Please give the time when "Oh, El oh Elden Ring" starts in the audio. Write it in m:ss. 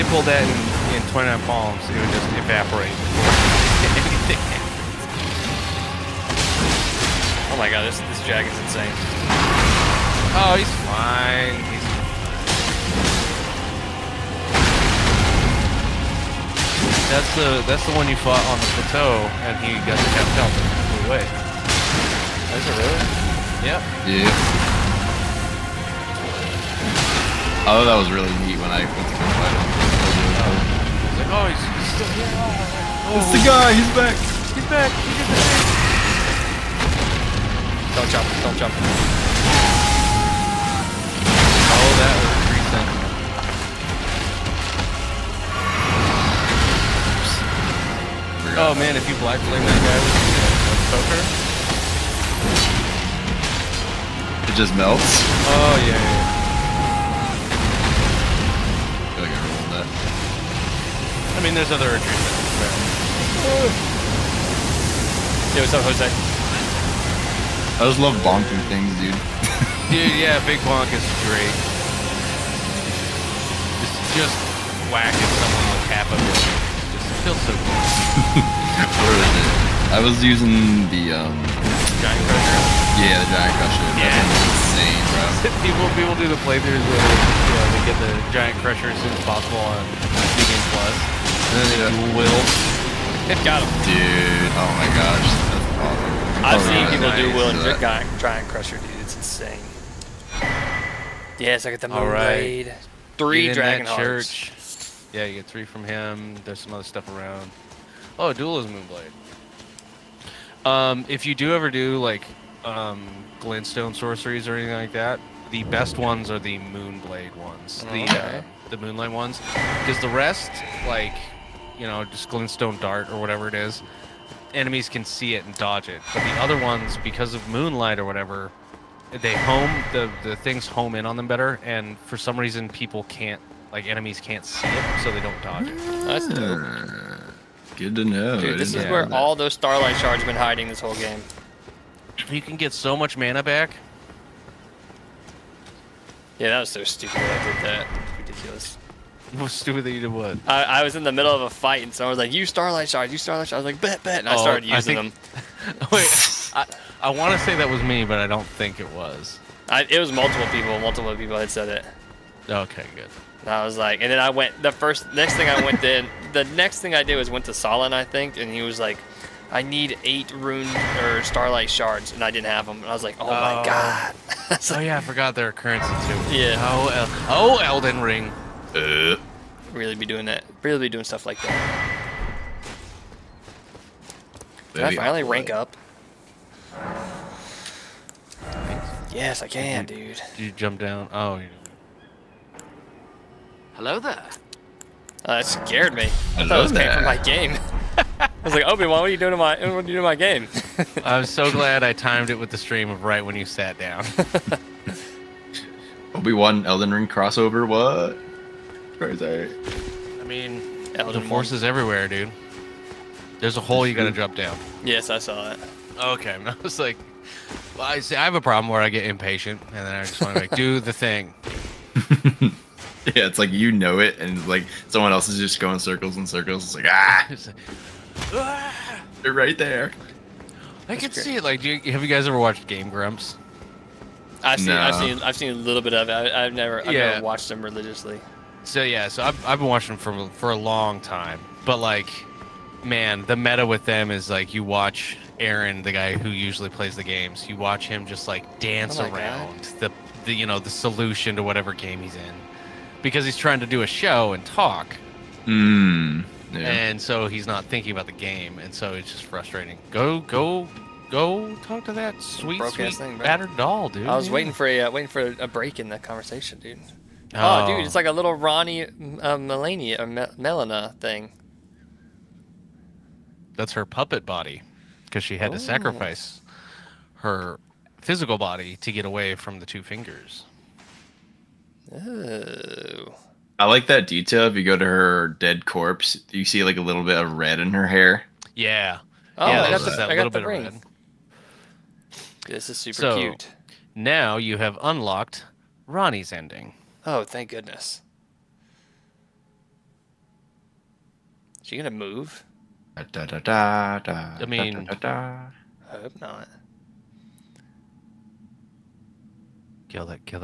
2:56.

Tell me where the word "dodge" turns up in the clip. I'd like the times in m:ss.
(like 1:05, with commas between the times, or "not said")
2:05, 2:15.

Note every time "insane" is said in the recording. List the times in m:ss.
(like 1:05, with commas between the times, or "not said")
0:08, 1:24, 1:39.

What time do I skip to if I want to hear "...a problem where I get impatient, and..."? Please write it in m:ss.
3:38.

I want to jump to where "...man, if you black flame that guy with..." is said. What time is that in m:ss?
0:48.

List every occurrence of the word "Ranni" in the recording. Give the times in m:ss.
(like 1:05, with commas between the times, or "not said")
4:28, 4:55.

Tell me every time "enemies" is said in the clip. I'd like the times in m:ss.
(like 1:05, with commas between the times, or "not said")
2:04, 2:13.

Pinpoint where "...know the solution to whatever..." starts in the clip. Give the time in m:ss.
4:10.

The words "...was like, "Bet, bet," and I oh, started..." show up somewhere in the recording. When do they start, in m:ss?
2:33.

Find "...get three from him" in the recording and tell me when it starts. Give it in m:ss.
1:45.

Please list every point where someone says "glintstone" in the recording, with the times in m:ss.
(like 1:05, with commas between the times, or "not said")
1:53, 2:02.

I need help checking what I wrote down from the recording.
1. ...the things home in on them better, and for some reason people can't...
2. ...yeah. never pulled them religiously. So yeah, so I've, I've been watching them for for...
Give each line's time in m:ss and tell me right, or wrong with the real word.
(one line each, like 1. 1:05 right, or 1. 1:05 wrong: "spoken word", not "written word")
1. 2:10 right
2. 3:56 wrong: "watched", not "pulled".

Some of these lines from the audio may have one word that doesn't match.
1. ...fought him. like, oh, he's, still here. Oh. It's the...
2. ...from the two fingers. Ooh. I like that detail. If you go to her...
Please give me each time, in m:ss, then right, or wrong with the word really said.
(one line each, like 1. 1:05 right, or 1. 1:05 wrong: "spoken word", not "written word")
1. 0:29 wrong: "fight", not "fought"
2. 4:39 right.